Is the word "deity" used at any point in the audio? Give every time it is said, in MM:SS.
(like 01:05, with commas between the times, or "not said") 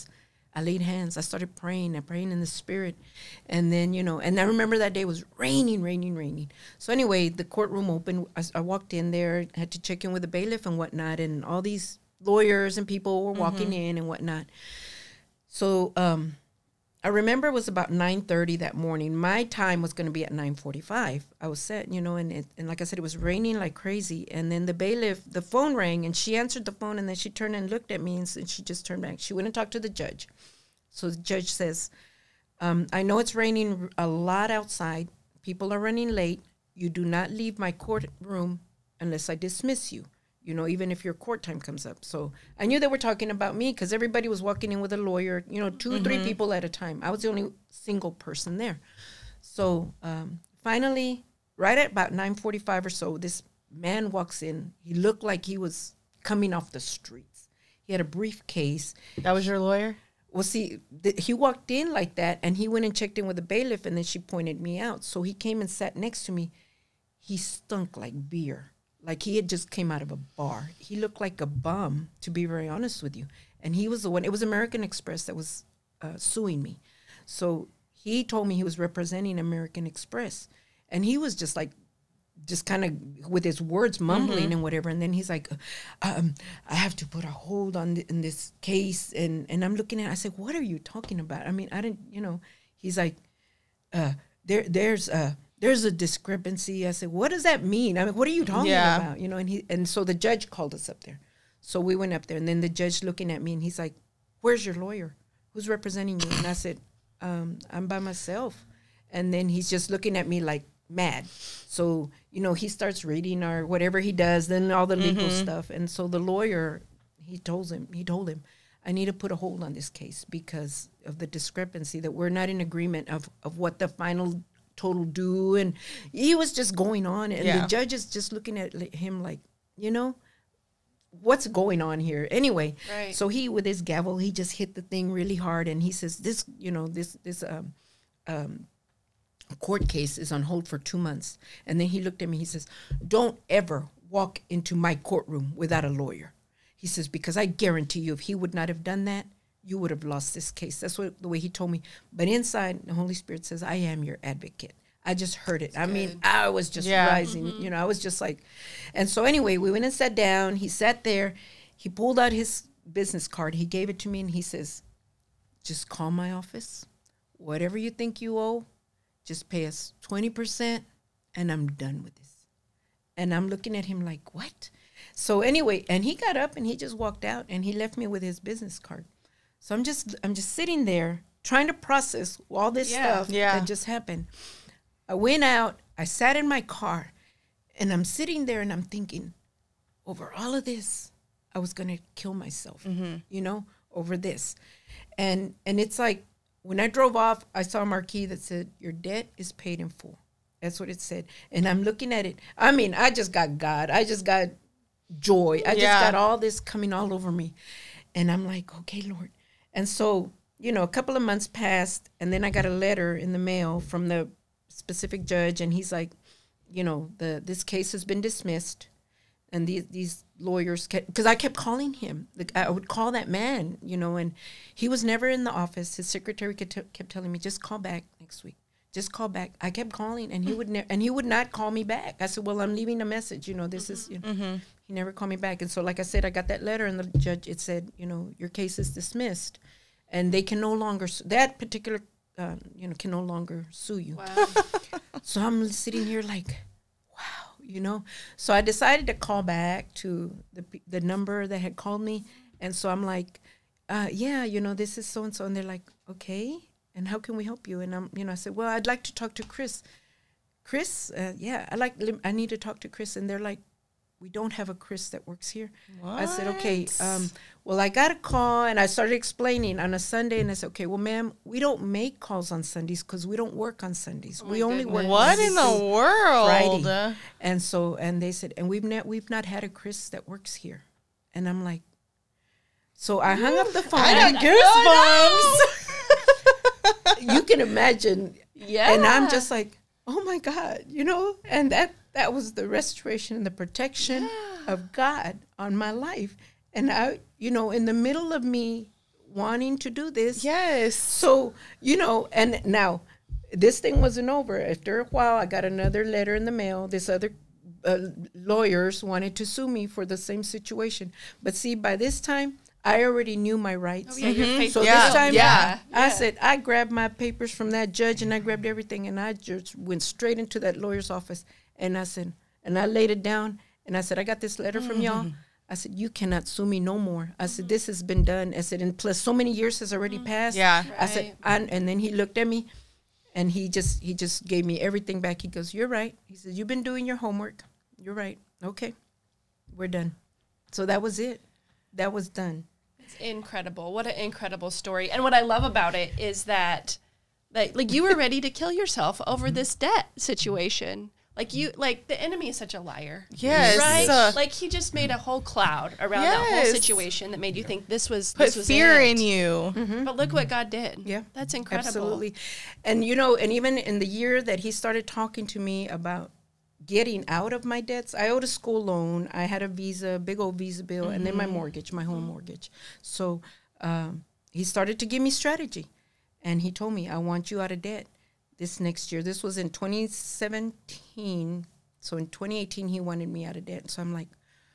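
not said.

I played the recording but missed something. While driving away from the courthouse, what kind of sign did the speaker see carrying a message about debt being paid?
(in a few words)
marquee.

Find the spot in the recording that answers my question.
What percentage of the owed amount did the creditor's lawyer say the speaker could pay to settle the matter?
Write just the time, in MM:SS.
02:50.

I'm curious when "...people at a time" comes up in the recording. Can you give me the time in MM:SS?
00:46.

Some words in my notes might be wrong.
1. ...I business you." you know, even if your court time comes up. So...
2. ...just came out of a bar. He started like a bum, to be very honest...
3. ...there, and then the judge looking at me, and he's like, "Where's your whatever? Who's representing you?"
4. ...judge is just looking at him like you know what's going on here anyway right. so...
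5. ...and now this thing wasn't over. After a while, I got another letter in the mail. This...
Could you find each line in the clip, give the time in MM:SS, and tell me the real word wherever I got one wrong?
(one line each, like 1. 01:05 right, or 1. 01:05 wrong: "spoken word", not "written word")
1. 00:39 wrong: "dismiss", not "business"
2. 01:09 wrong: "looked", not "started"
3. 01:42 wrong: "lawyer", not "whatever"
4. 02:07 right
5. 05:02 right.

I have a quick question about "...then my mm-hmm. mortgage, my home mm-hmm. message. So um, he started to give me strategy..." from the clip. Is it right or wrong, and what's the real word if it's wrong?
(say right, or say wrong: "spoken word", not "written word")
wrong: "mortgage", not "message".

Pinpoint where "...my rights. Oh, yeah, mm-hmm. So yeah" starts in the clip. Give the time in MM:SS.
05:13.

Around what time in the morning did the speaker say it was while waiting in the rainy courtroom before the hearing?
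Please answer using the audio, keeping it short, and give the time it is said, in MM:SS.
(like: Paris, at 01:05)
9:30, at 00:17.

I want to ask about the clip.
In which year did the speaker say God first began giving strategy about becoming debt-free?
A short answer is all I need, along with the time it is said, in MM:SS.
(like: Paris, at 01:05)
2017, at 06:19.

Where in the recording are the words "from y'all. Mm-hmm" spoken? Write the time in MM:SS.
05:24.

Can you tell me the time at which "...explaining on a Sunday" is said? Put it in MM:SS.
04:29.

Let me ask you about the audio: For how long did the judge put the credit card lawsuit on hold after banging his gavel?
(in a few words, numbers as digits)
two months.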